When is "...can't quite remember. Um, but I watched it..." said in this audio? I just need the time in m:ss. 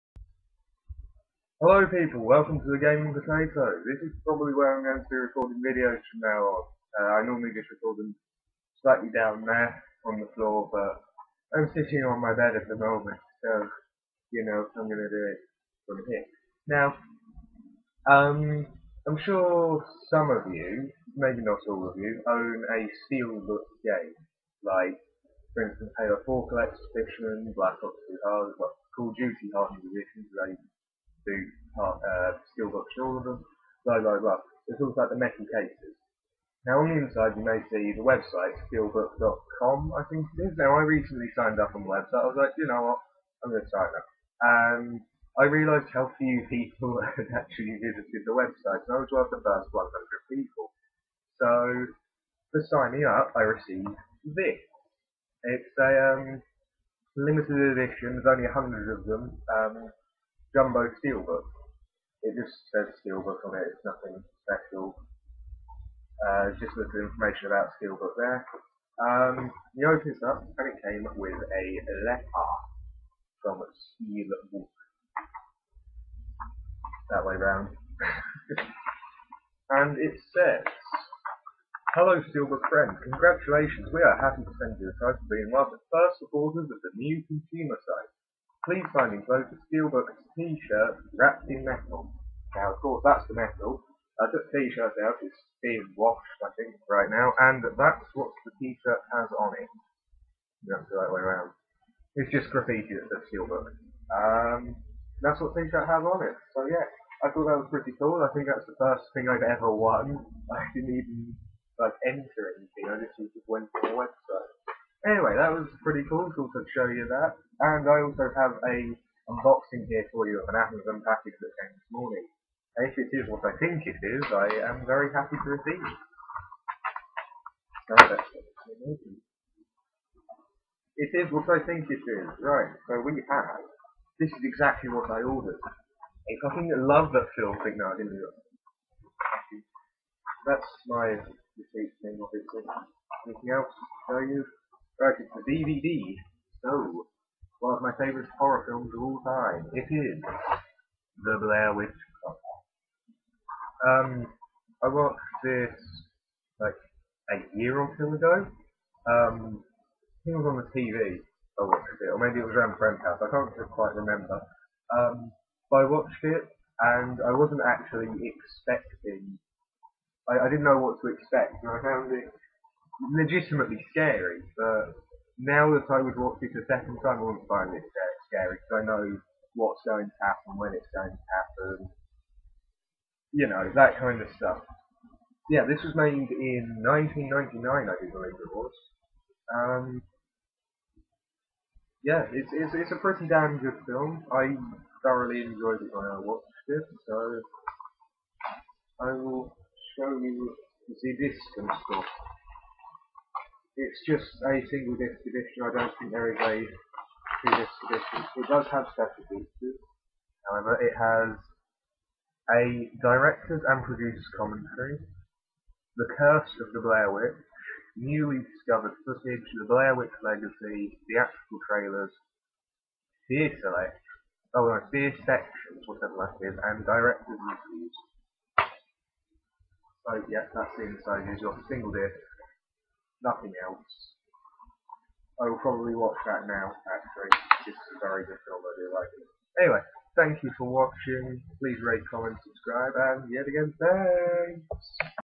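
2:43.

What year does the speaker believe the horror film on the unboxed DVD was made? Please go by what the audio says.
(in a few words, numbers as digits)
1999.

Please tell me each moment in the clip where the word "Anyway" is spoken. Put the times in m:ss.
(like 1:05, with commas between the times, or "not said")
1:55, 3:59.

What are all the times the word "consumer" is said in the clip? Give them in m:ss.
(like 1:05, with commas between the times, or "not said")
1:27.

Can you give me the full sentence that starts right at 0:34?
it's all about the metal cases.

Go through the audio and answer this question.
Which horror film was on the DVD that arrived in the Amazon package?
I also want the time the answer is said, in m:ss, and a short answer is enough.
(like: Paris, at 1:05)
The Blair Witch Project, at 2:31.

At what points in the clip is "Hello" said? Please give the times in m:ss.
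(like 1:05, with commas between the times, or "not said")
0:01, 1:21.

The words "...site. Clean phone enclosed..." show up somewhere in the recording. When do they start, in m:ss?
1:27.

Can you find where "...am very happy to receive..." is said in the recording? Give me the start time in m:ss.
2:04.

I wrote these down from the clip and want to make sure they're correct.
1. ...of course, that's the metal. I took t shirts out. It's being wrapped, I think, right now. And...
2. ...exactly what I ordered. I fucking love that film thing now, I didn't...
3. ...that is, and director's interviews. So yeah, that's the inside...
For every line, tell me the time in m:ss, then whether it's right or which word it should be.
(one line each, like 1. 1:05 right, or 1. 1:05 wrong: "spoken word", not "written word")
1. 1:32 wrong: "washed", not "wrapped"
2. 2:14 right
3. 3:46 right.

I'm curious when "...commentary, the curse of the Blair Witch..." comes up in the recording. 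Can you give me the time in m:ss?
3:34.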